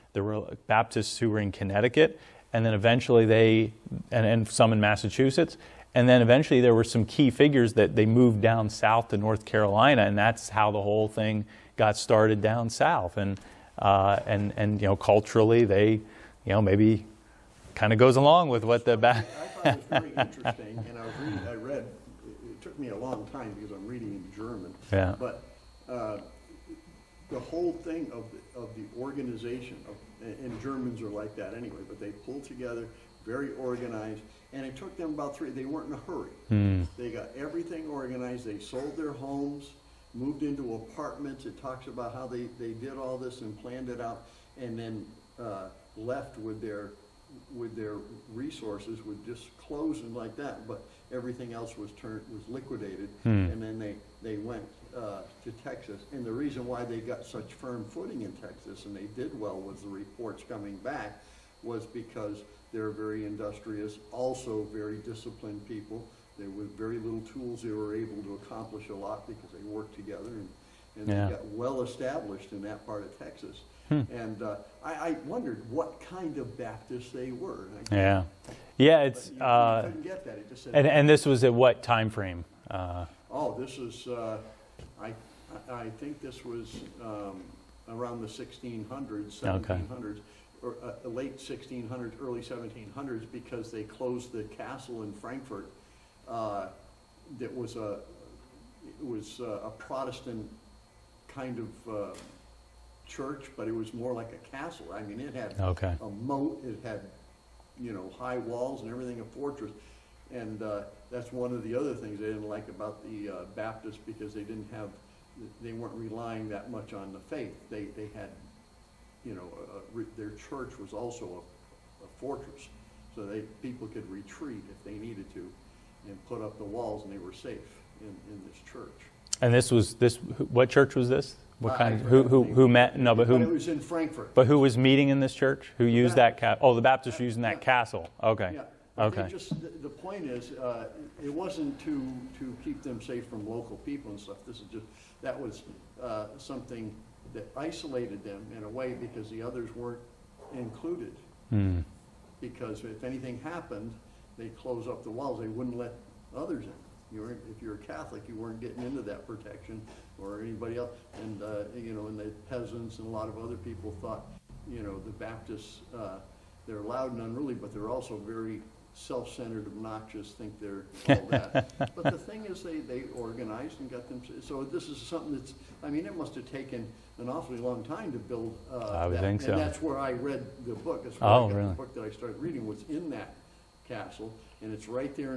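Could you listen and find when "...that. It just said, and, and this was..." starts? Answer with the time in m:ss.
1:20.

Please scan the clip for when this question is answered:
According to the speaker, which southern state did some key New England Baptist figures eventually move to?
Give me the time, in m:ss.
0:09.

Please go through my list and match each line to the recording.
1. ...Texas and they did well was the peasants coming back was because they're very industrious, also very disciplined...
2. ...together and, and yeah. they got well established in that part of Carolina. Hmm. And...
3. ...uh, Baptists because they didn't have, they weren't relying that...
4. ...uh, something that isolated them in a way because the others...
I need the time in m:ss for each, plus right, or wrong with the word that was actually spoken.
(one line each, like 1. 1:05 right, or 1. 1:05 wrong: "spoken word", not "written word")
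1. 0:58 wrong: "reports", not "peasants"
2. 1:09 wrong: "Texas", not "Carolina"
3. 1:53 right
4. 2:26 right.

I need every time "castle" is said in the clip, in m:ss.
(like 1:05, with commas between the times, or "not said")
1:34, 1:44, 2:17, 3:03.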